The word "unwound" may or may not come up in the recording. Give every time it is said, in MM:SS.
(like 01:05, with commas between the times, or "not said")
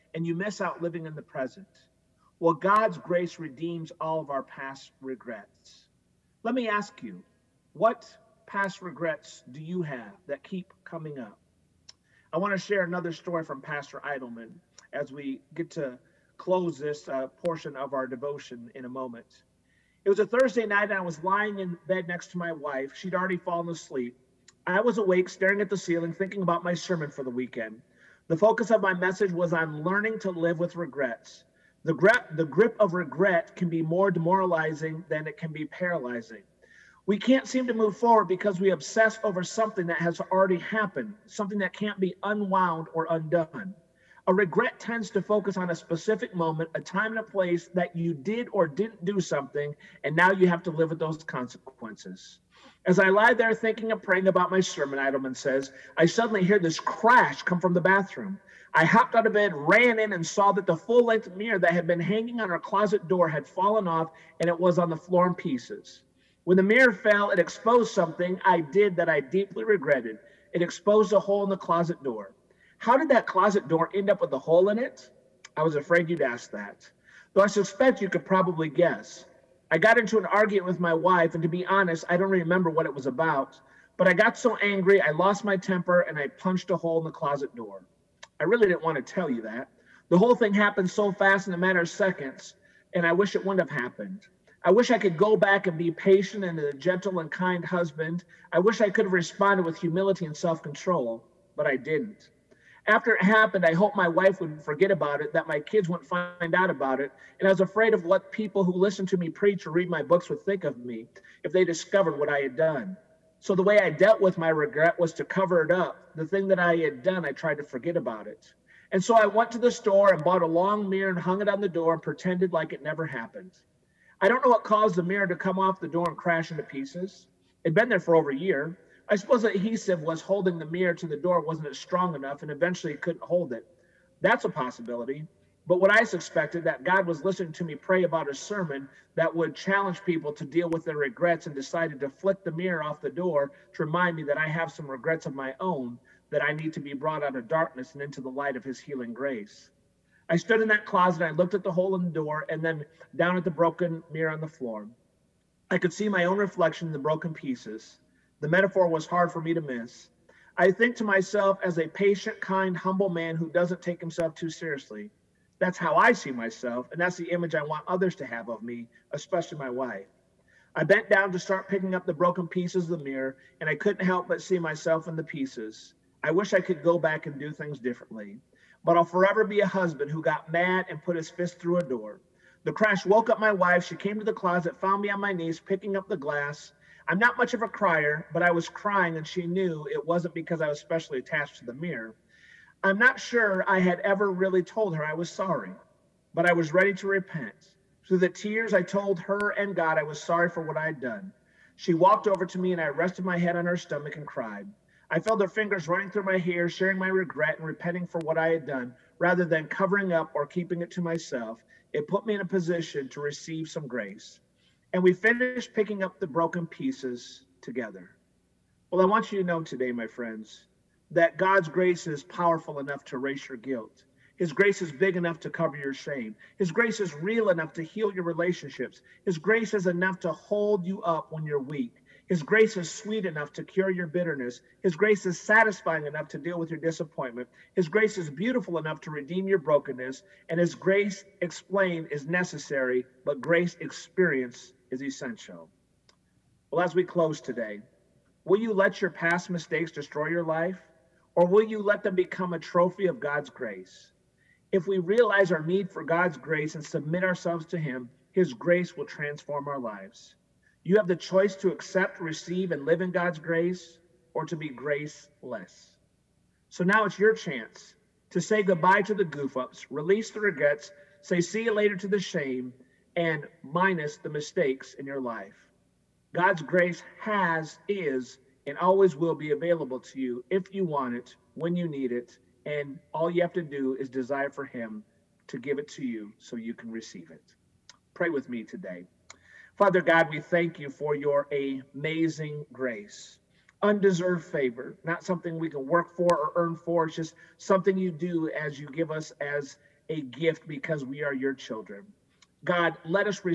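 00:42.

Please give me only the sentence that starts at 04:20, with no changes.
You have the choice to accept, receive, and live in God's grace or to be graceless.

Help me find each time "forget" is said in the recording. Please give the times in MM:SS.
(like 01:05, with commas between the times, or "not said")
01:44, 01:57.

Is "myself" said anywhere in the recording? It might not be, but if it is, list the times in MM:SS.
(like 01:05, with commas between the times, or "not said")
02:41, 02:46, 02:54, 03:31.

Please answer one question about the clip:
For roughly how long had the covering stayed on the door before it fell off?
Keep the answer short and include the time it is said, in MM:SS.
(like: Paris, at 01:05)
Over a year, at 02:08.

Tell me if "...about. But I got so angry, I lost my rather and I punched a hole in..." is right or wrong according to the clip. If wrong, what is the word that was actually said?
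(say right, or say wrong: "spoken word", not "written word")
wrong: "temper", not "rather".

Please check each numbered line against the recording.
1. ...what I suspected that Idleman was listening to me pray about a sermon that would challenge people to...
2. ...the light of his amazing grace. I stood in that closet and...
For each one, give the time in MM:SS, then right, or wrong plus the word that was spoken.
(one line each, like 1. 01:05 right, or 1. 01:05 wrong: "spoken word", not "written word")
1. 02:15 wrong: "God", not "Idleman"
2. 02:28 wrong: "healing", not "amazing".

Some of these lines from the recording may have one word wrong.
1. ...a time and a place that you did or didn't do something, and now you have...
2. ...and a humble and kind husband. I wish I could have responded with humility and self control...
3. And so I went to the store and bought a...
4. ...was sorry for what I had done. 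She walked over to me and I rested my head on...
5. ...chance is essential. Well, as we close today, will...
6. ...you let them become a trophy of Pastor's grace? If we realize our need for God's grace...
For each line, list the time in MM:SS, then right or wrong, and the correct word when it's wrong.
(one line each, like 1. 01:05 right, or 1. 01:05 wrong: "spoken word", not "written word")
1. 00:46 right
2. 01:36 wrong: "gentle", not "humble"
3. 01:58 right
4. 03:20 right
5. 04:03 wrong: "experience", not "chance"
6. 04:11 wrong: "God", not "Pastor".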